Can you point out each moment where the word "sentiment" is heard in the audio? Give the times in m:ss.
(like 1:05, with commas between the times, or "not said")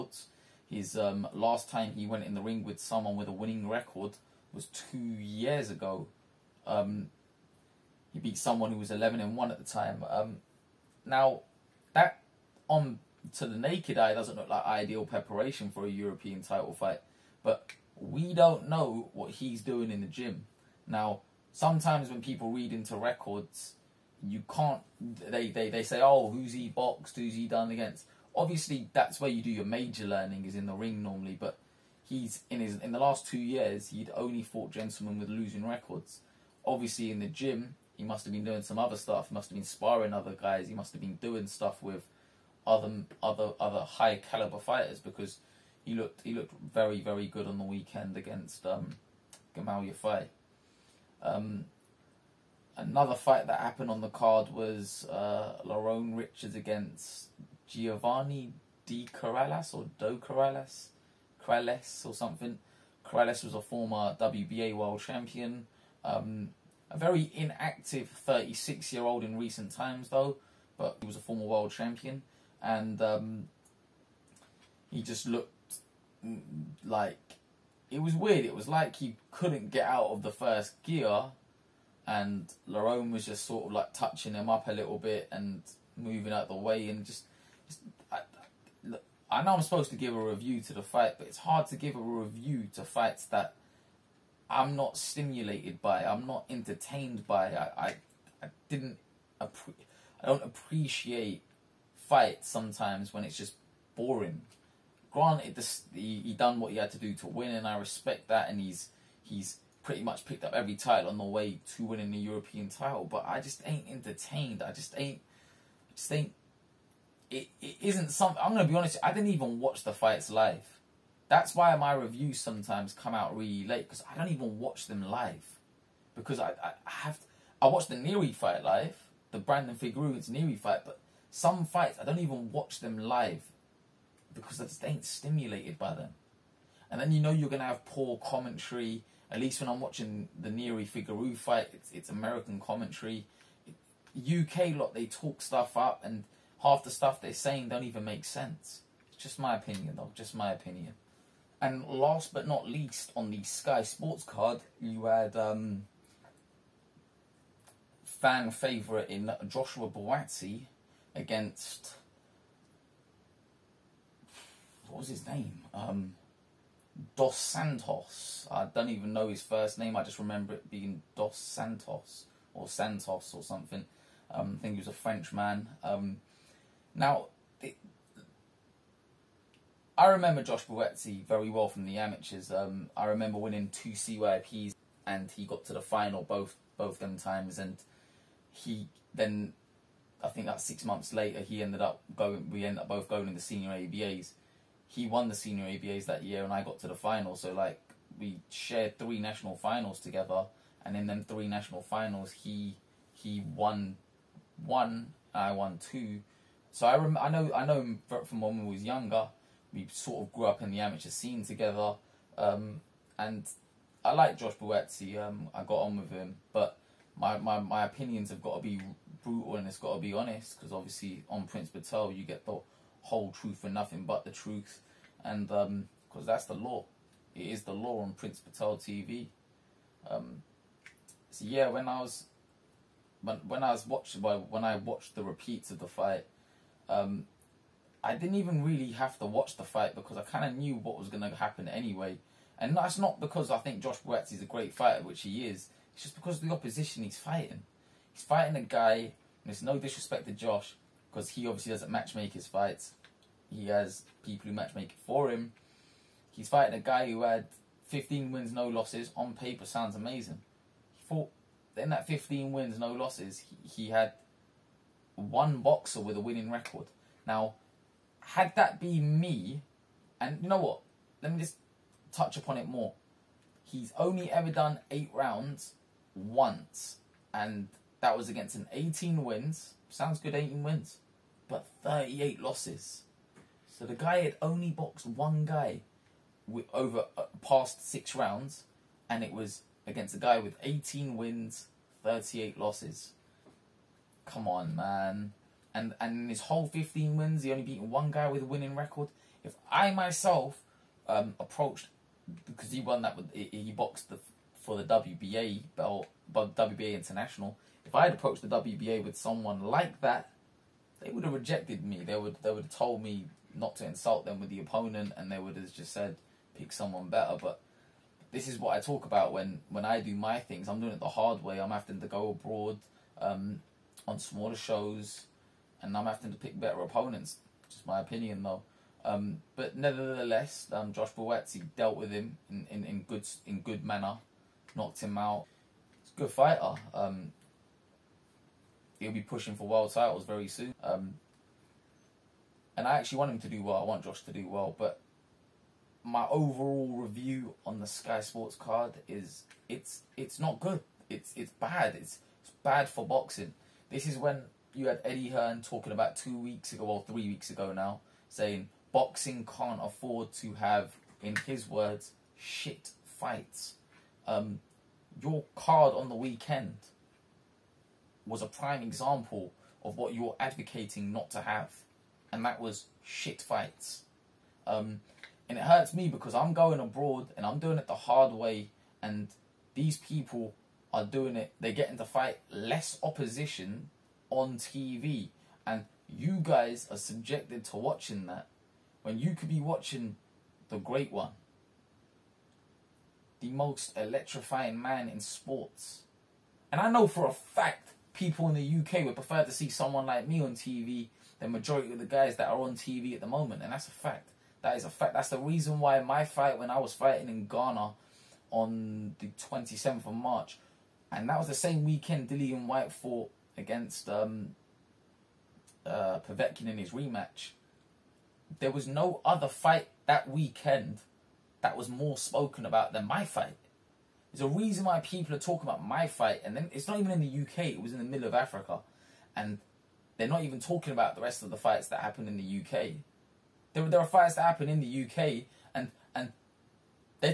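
not said.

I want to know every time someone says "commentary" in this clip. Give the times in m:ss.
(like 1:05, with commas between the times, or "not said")
2:18, 2:22.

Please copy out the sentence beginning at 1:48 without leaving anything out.
And he's he's pretty much picked up every title on the way to winning the European title.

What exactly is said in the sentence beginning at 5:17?
But this is what I talk about when when I do my things.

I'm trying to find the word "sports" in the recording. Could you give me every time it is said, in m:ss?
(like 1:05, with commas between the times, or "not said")
2:33, 5:48, 6:35.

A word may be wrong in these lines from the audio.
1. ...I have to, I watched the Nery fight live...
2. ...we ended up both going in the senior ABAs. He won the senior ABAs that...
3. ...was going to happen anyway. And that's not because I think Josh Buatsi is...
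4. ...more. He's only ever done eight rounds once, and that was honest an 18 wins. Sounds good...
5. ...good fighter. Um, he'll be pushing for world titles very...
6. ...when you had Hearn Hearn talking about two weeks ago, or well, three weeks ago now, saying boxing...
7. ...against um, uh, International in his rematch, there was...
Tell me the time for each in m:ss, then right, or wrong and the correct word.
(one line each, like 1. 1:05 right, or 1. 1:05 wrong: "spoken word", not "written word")
1. 2:06 right
2. 3:12 right
3. 4:00 right
4. 4:32 wrong: "against", not "honest"
5. 5:36 right
6. 5:54 wrong: "Eddie", not "Hearn"
7. 6:53 wrong: "Povetkin", not "International".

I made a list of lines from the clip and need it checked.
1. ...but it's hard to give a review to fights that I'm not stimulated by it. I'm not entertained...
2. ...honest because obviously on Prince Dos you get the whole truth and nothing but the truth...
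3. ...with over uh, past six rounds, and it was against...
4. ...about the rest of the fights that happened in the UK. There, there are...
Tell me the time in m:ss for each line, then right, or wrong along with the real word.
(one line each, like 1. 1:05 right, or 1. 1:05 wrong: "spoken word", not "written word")
1. 1:31 right
2. 3:40 wrong: "Patel", not "Dos"
3. 4:46 right
4. 7:10 right.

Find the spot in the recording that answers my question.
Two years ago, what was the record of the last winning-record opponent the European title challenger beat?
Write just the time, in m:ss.
0:08.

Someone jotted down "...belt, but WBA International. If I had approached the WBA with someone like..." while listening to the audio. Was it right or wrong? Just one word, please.
right.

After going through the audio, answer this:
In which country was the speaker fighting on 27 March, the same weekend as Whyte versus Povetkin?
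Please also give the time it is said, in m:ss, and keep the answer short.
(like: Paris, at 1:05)
Ghana, at 6:47.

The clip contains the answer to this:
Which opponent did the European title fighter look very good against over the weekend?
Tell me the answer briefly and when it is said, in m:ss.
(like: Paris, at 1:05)
Gamal Yafai, at 0:49.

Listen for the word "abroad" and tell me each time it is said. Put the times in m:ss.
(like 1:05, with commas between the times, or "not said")
5:22, 6:16.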